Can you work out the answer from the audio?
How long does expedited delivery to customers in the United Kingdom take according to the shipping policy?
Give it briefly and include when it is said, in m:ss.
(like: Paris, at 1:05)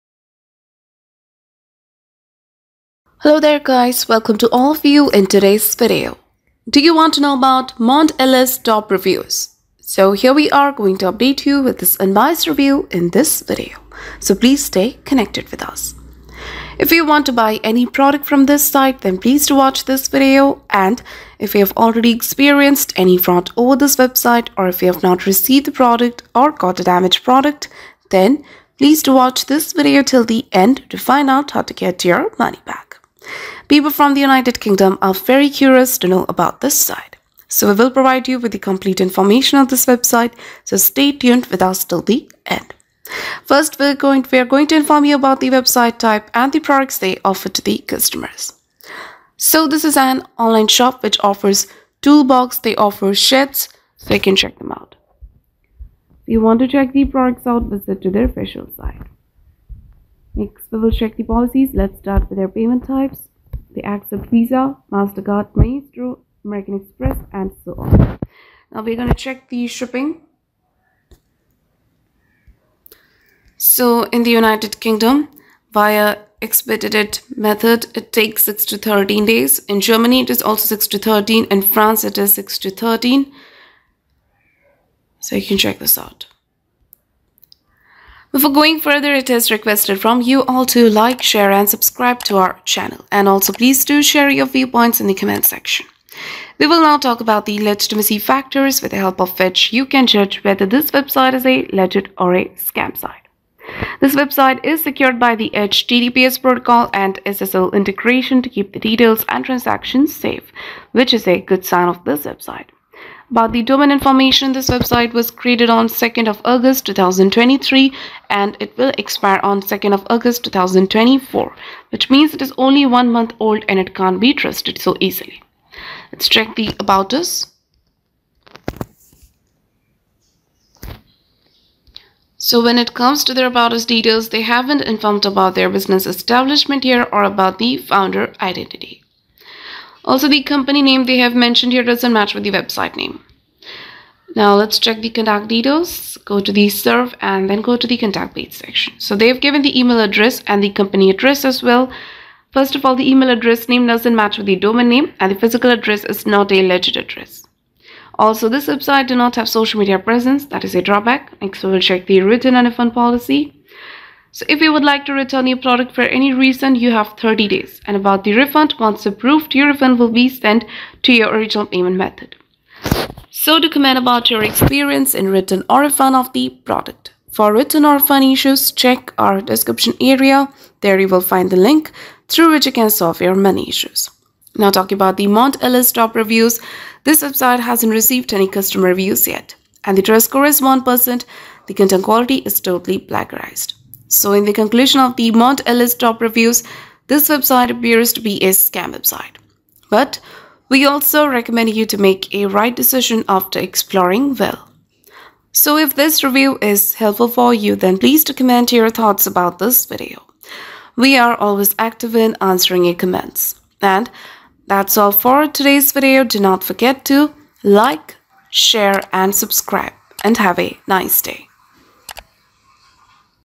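6 to 13 days, at 1:18.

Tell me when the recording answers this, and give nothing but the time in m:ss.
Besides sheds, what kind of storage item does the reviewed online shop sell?
0:52.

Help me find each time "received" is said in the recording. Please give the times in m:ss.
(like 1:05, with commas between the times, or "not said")
0:25, 3:07.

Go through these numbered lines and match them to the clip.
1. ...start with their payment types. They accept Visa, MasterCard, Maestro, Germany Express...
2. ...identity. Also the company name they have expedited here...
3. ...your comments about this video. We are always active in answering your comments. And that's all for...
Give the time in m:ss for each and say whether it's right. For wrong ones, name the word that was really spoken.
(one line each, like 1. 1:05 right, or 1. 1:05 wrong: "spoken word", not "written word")
1. 1:01 wrong: "American", not "Germany"
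2. 2:18 wrong: "mentioned", not "expedited"
3. 3:28 wrong: "thoughts", not "comments".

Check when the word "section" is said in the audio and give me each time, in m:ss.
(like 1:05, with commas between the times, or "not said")
1:35, 2:28.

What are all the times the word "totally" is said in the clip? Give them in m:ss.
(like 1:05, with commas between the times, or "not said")
3:12.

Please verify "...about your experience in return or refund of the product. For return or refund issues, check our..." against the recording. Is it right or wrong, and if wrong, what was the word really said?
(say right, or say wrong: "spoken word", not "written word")
right.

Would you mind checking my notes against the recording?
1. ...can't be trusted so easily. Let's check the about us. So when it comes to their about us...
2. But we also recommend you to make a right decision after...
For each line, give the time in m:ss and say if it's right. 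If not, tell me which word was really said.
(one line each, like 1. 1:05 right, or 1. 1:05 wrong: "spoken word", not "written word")
1. 2:03 right
2. 3:19 right.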